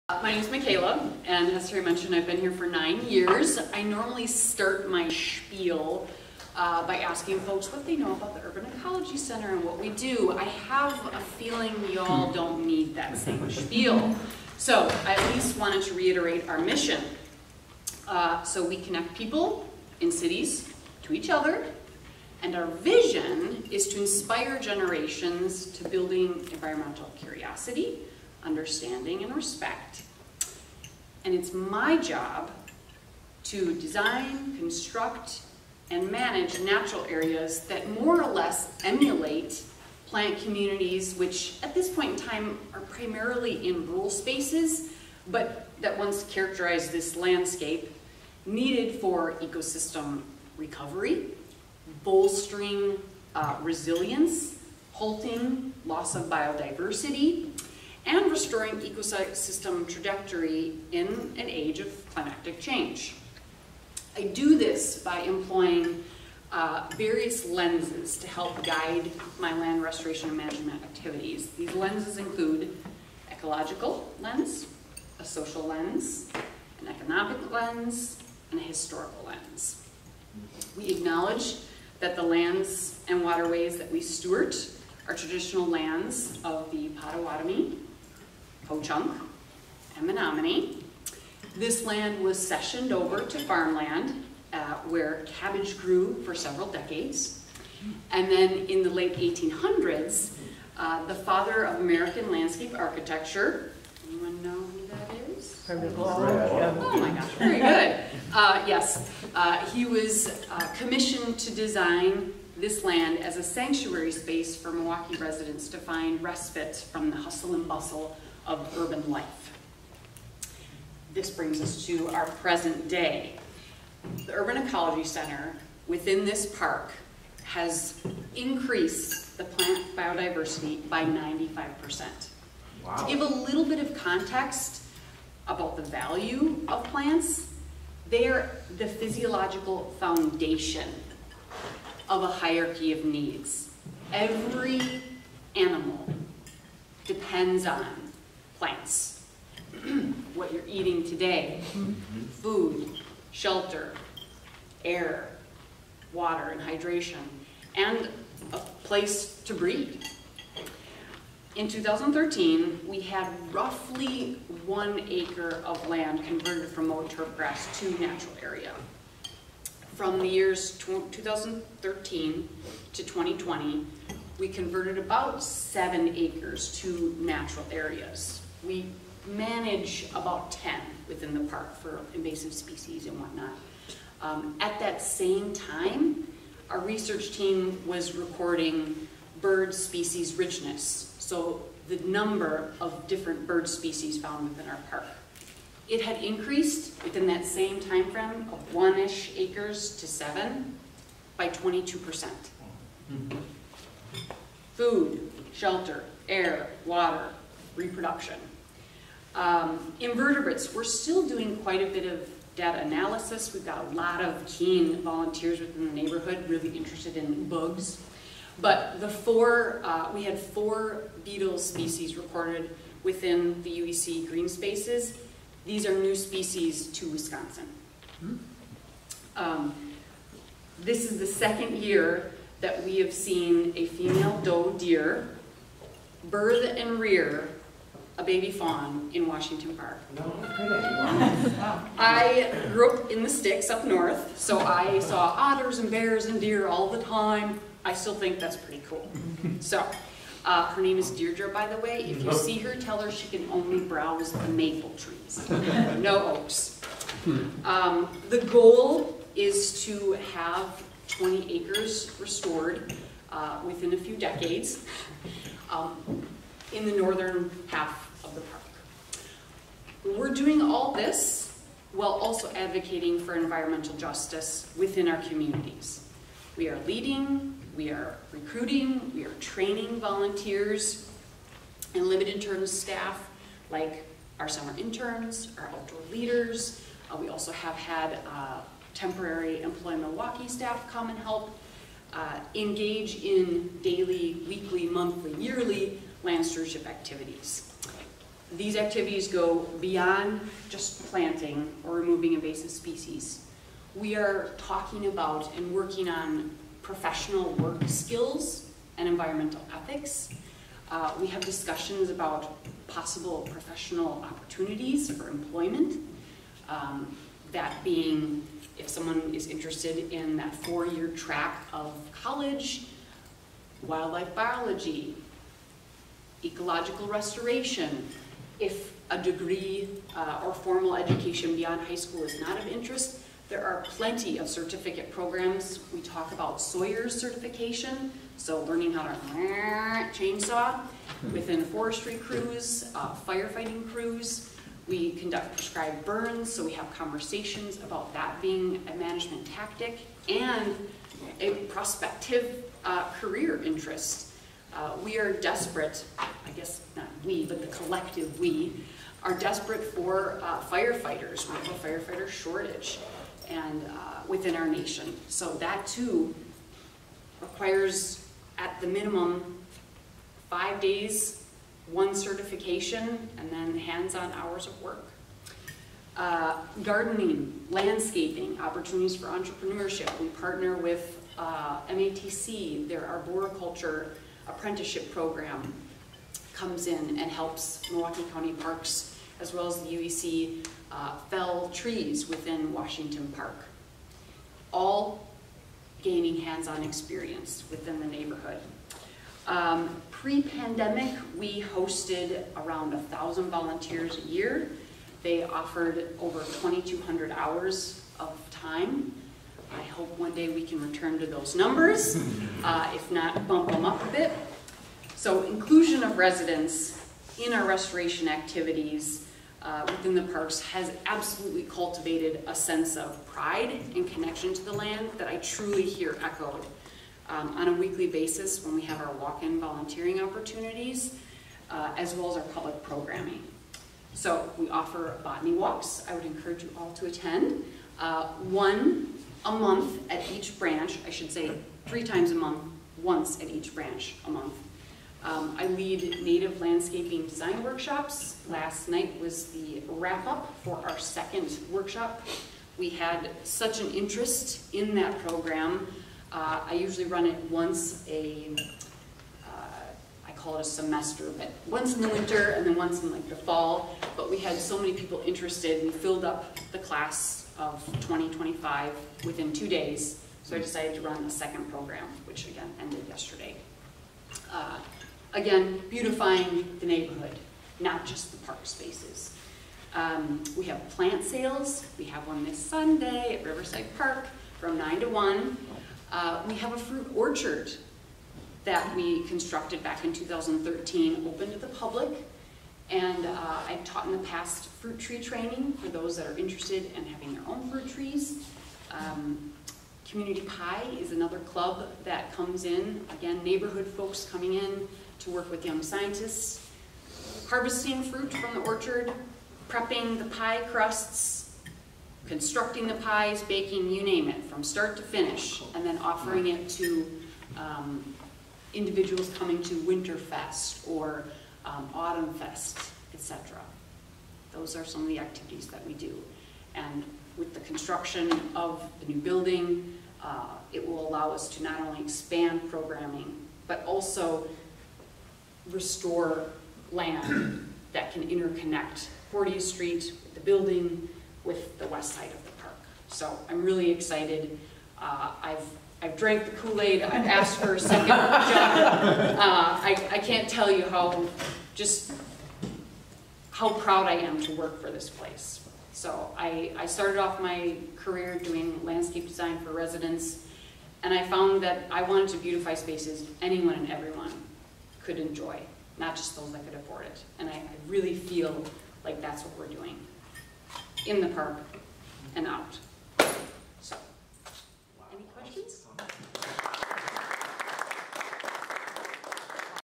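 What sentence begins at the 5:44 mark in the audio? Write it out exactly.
We conduct prescribed burns, so we have conversations about that being a management tactic and a prospective uh, career interest.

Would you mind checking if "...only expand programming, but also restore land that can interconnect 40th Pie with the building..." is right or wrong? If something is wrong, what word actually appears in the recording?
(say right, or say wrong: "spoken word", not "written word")
wrong: "Street", not "Pie".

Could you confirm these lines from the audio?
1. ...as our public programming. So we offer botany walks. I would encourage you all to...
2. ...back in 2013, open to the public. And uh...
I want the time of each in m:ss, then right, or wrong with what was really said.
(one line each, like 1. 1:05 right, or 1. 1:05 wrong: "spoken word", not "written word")
1. 7:12 right
2. 8:09 right.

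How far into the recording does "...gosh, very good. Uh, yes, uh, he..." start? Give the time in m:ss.
1:47.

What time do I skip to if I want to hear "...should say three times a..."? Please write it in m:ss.
7:21.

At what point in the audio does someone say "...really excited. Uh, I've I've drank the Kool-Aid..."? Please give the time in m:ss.
9:03.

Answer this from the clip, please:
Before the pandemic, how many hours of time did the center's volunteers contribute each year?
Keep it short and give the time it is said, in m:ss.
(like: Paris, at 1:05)
2,200, at 6:46.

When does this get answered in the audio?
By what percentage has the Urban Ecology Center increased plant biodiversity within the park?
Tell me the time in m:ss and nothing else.
2:11.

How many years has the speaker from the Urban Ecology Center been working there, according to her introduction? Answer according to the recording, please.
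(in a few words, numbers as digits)
9.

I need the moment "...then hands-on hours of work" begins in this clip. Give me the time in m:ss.
6:13.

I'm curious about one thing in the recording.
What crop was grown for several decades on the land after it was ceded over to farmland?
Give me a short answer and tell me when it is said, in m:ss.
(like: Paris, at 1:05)
cabbage, at 1:35.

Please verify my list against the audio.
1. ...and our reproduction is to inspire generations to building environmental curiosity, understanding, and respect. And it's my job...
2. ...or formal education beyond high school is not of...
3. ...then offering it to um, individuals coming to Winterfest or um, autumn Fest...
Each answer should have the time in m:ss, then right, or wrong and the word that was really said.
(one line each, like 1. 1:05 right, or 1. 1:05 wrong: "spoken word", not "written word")
1. 0:22 wrong: "vision", not "reproduction"
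2. 5:30 right
3. 8:35 right.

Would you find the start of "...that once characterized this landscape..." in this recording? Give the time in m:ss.
0:45.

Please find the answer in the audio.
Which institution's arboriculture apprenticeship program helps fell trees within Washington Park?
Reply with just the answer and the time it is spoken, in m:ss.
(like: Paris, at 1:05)
MATC, at 6:21.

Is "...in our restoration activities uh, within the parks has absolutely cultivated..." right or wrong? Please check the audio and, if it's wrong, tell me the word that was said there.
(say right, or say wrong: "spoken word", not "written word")
right.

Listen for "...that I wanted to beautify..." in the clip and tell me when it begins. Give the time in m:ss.
9:21.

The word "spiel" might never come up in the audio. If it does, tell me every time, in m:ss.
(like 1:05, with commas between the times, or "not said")
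0:05, 0:13.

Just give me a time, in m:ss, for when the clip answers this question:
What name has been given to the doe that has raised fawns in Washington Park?
4:11.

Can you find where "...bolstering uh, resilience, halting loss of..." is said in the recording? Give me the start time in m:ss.
0:52.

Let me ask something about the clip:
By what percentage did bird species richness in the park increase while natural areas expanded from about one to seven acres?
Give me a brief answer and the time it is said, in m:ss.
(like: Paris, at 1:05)
22%, at 3:21.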